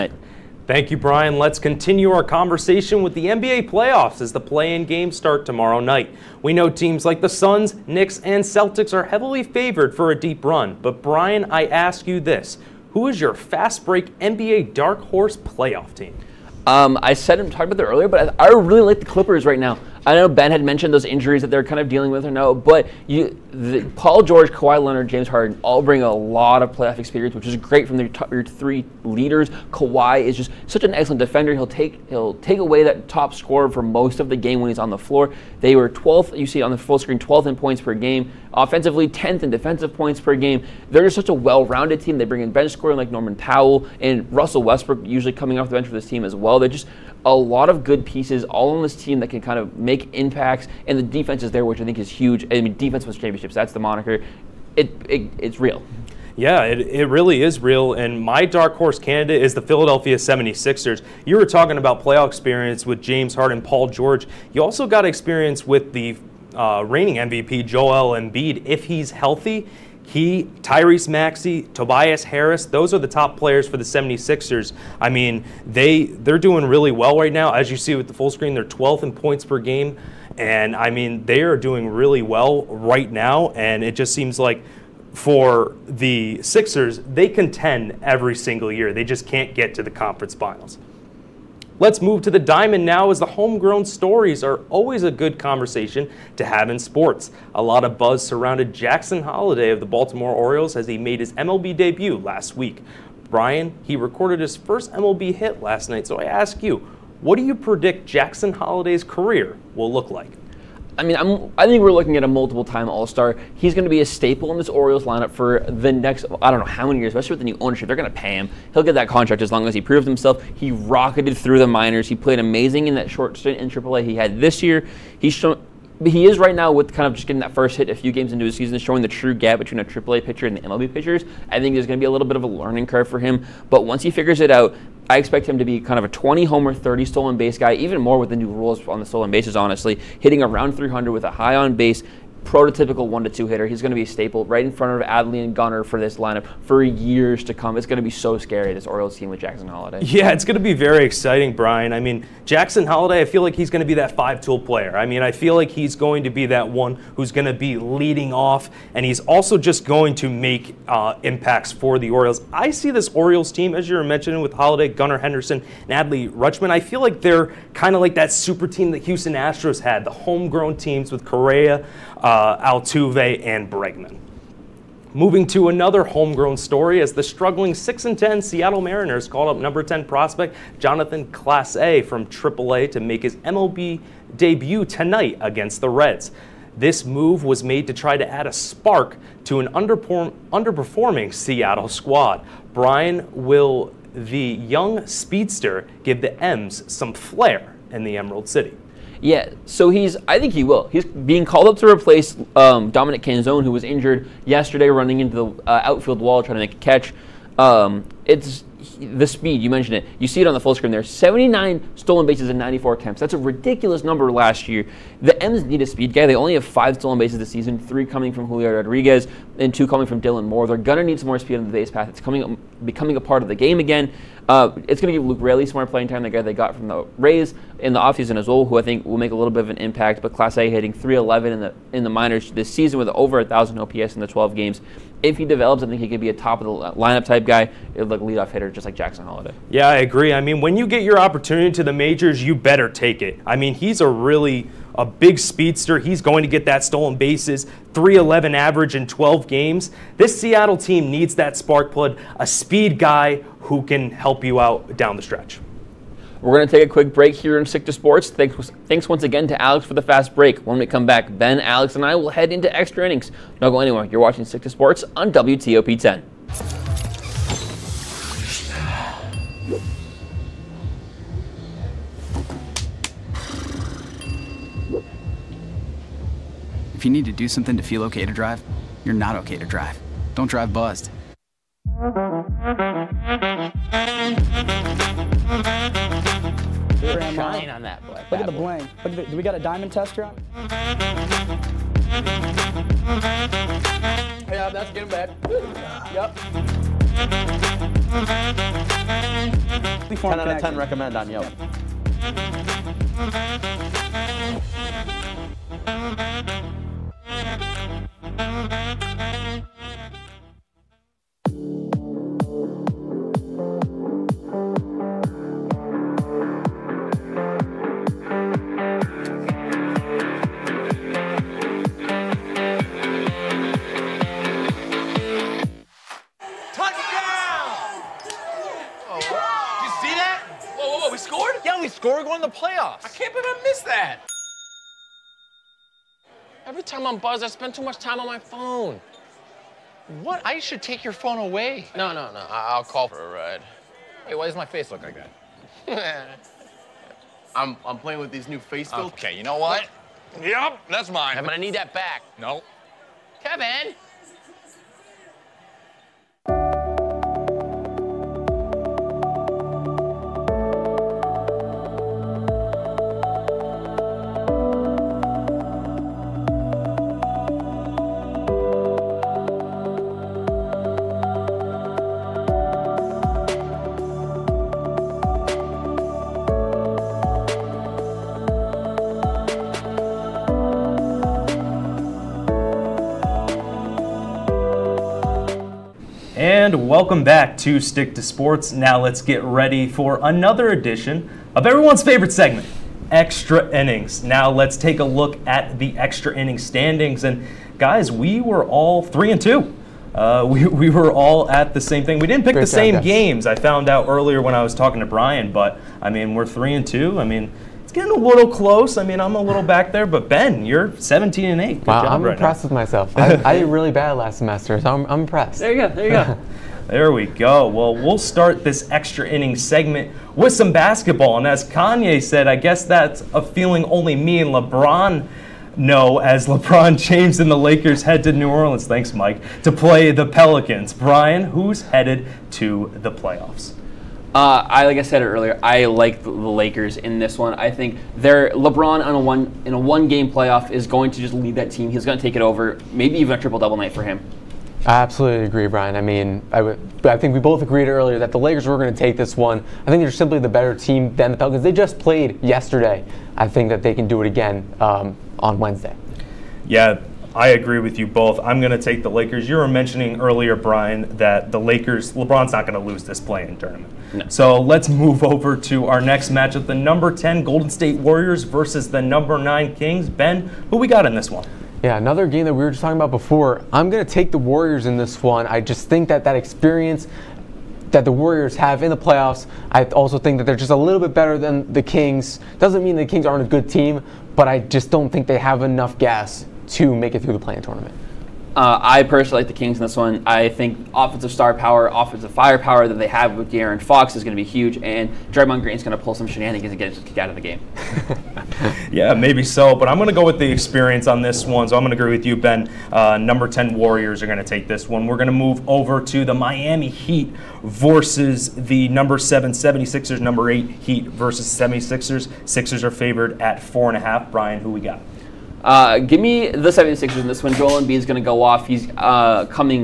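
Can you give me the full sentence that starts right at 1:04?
You also got experience with the uh, reigning MVP, Joel Embiid, if he's healthy.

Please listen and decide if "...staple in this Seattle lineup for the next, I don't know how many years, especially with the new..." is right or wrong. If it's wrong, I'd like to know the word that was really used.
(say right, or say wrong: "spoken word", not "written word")
wrong: "Orioles", not "Seattle".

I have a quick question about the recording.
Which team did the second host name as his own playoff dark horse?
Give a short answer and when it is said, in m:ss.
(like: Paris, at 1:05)
Philadelphia 76ers, at 0:59.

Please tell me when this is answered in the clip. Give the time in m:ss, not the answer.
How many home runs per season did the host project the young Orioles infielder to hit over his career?
2:16.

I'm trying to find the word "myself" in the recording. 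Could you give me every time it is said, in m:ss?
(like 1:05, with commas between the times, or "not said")
6:52.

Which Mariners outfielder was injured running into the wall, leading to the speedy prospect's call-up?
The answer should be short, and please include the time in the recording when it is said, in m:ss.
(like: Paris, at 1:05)
Dominic Canzone, at 3:22.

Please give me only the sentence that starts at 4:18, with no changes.
Thanks, thanks once again to Alex for the fast break.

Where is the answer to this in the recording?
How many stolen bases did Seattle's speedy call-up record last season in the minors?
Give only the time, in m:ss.
3:31.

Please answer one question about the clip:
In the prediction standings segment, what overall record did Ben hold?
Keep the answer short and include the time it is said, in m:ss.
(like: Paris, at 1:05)
17 and 8, at 6:50.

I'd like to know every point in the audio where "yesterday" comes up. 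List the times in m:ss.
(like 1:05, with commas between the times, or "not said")
3:24, 7:32.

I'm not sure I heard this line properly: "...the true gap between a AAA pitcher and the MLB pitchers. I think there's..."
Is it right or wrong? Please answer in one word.
right.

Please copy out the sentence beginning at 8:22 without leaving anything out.
Uh, number 10 Warriors are going to take this one.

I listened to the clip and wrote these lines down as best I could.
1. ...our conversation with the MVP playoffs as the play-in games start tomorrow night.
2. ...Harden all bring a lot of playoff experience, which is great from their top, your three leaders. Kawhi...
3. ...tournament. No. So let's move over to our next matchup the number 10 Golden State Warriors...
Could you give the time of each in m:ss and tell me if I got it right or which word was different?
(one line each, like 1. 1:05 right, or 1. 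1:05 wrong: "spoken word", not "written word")
1. 0:02 wrong: "NBA", not "MVP"
2. 0:25 right
3. 7:43 right.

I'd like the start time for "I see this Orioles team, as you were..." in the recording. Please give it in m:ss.
2:42.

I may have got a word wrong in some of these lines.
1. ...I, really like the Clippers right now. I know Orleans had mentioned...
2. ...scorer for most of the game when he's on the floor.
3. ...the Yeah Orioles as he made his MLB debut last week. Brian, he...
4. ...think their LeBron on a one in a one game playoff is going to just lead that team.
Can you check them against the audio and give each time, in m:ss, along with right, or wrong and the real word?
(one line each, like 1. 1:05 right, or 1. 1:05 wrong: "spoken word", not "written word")
1. 0:18 wrong: "Ben", not "Orleans"
2. 0:33 right
3. 1:39 wrong: "Baltimore", not "Yeah"
4. 7:17 right.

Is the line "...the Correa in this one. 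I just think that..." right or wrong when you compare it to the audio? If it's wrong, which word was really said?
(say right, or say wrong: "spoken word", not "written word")
wrong: "Warriors", not "Correa".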